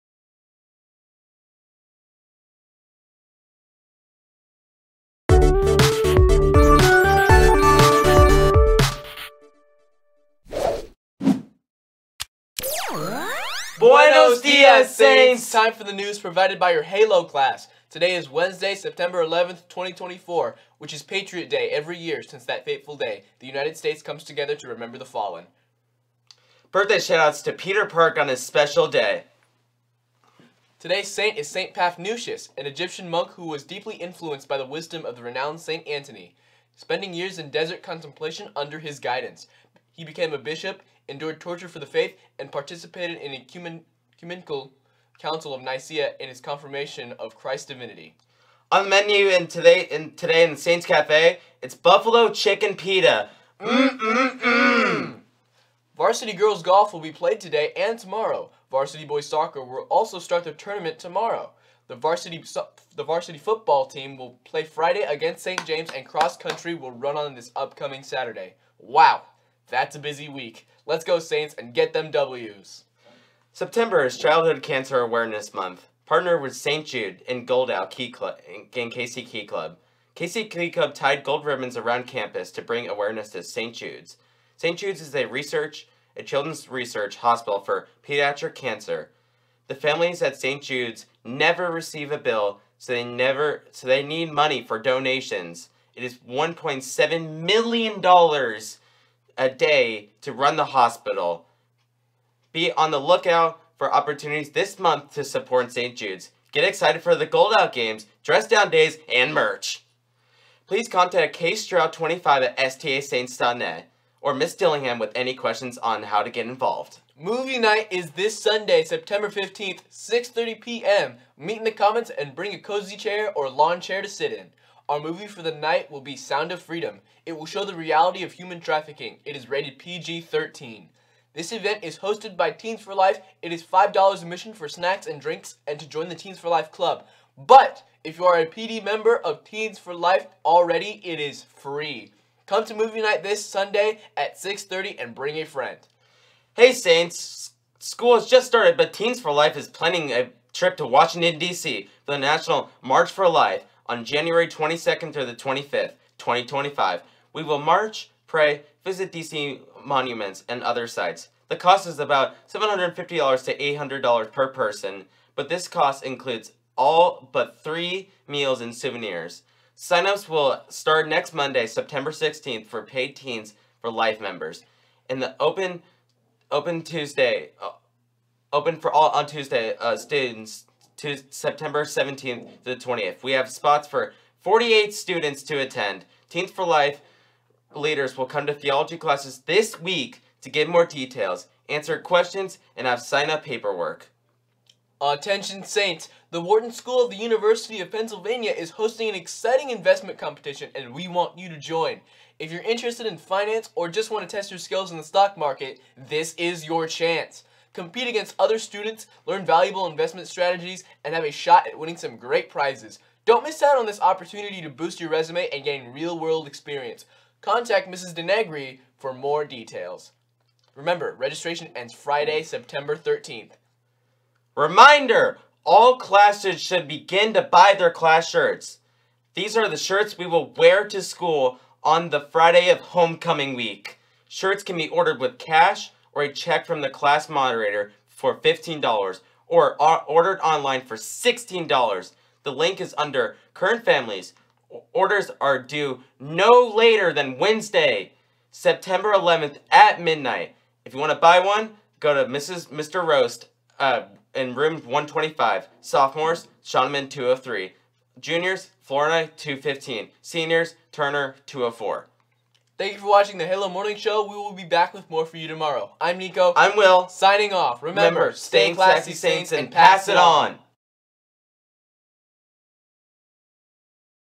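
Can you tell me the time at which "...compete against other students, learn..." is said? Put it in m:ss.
3:27.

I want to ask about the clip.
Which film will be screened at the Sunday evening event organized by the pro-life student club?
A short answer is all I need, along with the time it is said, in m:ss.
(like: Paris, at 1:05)
Sound of Freedom, at 2:06.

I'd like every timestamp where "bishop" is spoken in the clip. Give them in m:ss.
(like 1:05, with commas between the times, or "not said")
0:40.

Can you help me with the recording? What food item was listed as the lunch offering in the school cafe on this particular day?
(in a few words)
buffalo chicken pita.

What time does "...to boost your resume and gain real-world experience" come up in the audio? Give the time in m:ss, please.
3:34.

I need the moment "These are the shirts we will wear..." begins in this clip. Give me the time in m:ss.
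3:49.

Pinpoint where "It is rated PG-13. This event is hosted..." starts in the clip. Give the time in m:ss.
2:09.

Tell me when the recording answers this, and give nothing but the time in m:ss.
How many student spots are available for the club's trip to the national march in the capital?
3:04.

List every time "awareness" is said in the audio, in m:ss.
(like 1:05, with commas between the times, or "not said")
1:14, 1:22.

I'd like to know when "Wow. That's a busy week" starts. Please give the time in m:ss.
1:08.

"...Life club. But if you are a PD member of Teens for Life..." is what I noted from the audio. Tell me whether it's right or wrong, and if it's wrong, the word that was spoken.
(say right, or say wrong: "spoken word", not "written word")
right.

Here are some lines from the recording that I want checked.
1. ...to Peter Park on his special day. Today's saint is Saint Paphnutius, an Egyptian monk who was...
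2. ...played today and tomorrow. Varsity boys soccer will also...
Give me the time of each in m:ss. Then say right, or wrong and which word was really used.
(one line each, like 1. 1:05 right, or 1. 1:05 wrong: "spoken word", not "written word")
1. 0:27 right
2. 0:57 right.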